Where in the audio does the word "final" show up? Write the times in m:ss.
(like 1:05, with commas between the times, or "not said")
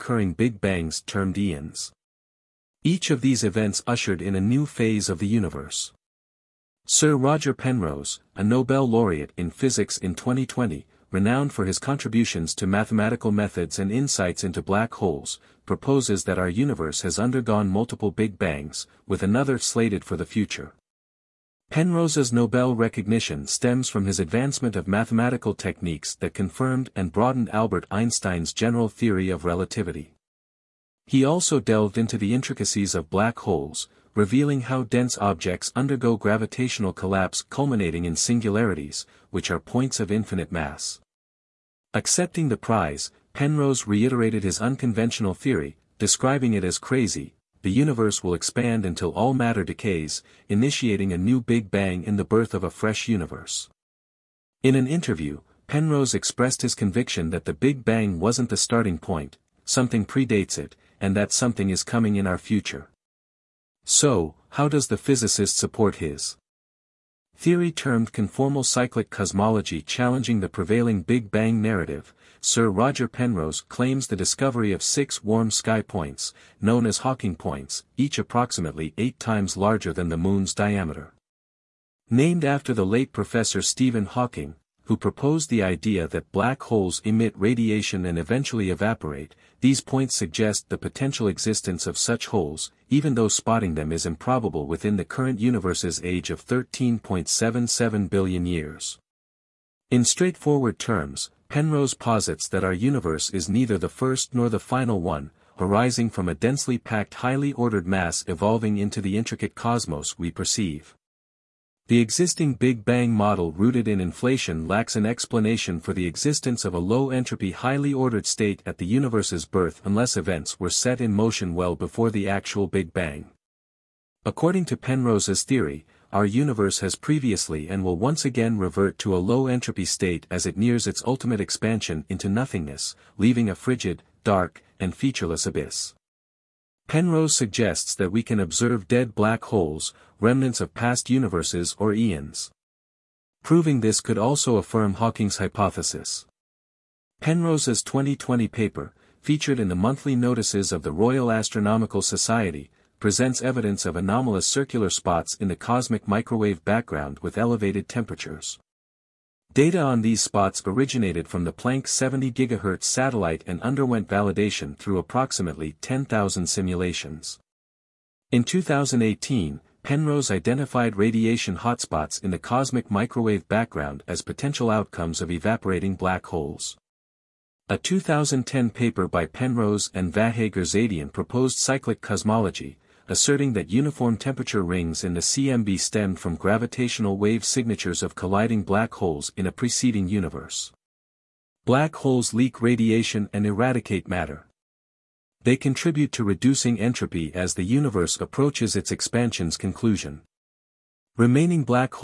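1:44.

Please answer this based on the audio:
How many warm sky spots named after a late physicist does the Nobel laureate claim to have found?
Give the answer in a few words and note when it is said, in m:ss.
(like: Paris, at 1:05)
6, at 1:14.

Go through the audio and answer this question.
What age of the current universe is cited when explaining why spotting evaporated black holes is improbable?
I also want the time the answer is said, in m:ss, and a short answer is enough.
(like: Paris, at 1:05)
13.77 billion years, at 1:36.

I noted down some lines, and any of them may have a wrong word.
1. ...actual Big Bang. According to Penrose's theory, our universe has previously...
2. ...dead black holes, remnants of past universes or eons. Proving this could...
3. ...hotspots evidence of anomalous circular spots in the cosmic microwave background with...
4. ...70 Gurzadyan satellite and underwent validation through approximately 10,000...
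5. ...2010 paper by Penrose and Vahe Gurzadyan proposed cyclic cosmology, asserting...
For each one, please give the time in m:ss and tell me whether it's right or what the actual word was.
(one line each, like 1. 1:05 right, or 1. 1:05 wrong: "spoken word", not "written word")
1. 2:02 right
2. 2:18 right
3. 2:32 wrong: "presents", not "hotspots"
4. 2:41 wrong: "GHz", not "Gurzadyan"
5. 2:57 right.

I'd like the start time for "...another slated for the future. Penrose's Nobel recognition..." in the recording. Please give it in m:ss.
0:19.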